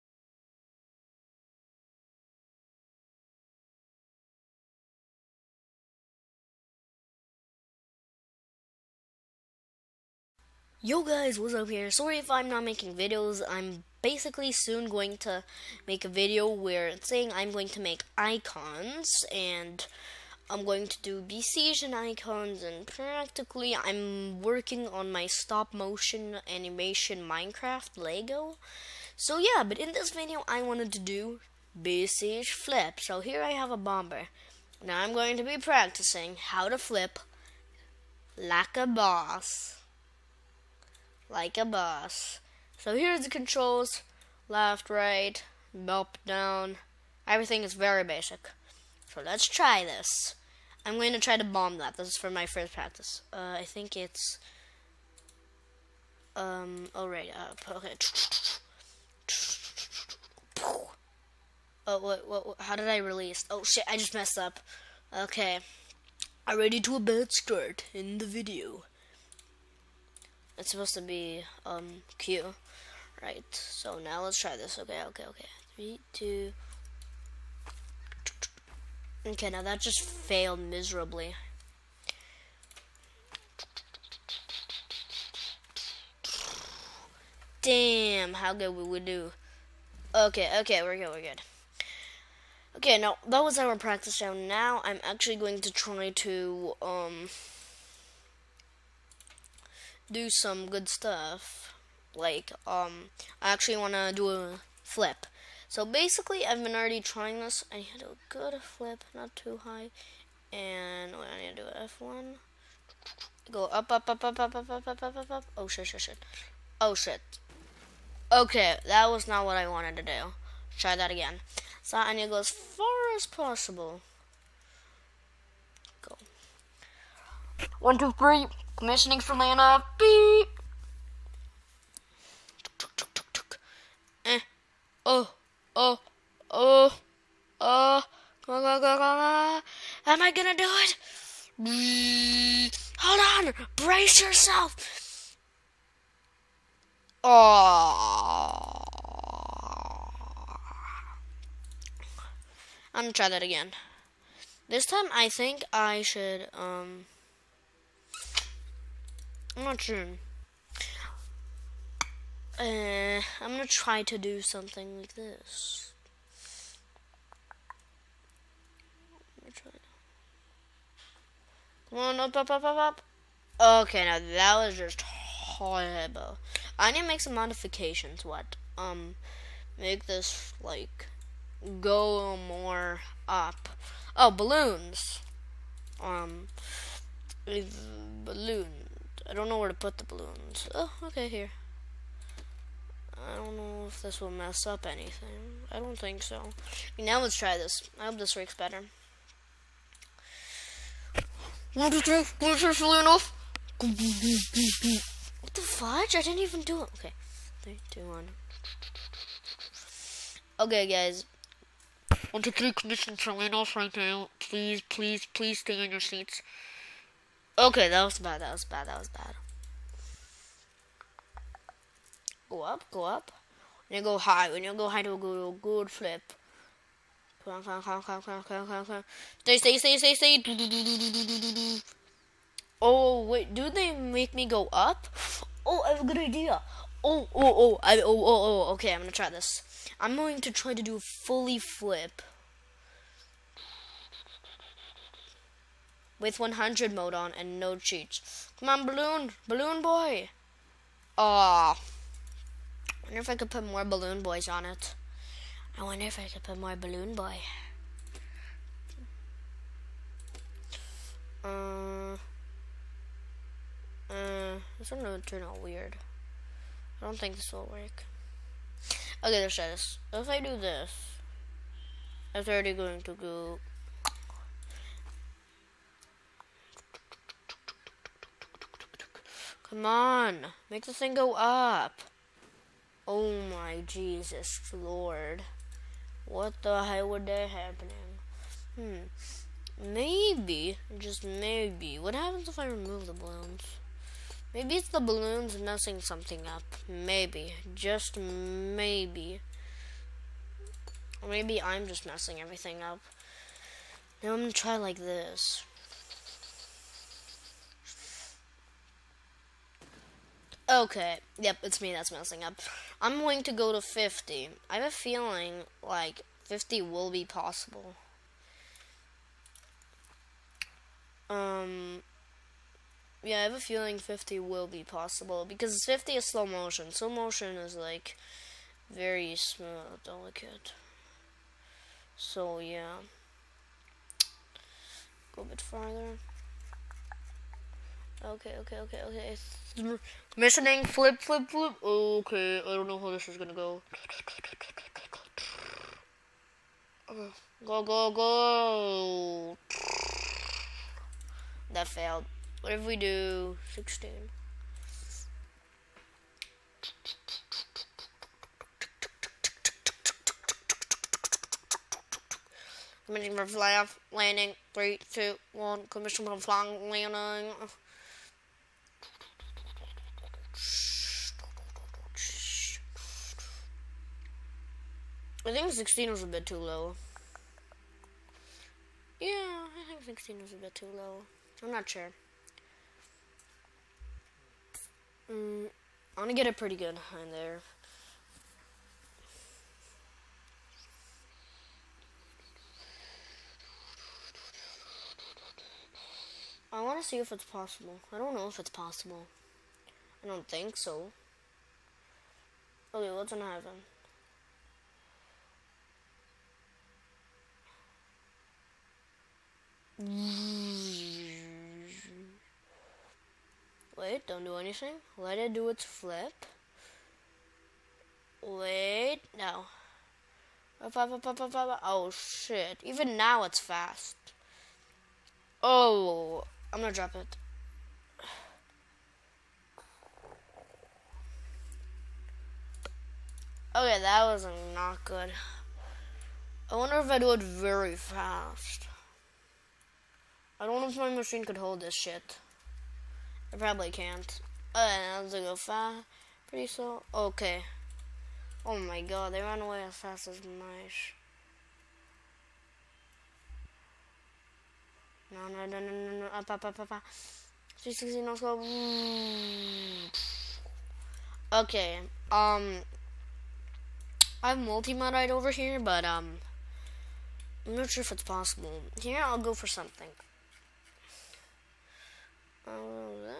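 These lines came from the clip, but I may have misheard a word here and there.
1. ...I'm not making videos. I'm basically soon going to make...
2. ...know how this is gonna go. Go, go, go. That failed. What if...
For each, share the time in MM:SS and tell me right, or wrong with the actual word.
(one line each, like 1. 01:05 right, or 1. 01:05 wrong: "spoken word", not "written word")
1. 00:12 right
2. 05:42 right.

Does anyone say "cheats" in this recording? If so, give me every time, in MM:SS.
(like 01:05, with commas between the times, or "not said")
04:07.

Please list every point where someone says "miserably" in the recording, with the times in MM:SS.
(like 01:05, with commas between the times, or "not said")
01:20.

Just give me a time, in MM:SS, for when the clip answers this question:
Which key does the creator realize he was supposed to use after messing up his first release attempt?
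01:12.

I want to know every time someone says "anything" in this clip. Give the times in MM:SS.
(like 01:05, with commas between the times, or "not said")
03:14, 06:54.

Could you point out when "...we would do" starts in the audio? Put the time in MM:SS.
01:28.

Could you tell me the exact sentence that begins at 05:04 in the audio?
Now I'm gonna try like this.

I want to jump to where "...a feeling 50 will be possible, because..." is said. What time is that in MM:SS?
05:23.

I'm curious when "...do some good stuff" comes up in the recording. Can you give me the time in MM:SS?
01:40.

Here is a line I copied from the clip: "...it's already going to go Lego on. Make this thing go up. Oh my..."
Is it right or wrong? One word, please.
wrong.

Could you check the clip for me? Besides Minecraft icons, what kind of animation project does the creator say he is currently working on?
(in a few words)
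Stop motion animation.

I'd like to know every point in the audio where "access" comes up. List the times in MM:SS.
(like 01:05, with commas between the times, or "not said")
not said.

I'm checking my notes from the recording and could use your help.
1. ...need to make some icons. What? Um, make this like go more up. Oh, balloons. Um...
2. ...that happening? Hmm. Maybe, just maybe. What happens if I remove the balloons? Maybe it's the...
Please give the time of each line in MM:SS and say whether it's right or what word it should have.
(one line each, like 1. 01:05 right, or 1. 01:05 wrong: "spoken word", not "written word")
1. 02:56 wrong: "modifications", not "icons"
2. 04:47 right.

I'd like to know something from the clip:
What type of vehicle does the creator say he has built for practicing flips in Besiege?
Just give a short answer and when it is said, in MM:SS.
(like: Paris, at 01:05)
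A bomber, at 00:33.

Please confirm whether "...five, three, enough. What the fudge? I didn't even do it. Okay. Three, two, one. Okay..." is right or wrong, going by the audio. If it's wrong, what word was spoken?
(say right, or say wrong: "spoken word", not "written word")
wrong: "two", not "five".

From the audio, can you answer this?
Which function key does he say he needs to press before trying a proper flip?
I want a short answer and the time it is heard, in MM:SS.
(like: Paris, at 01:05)
F1, at 01:51.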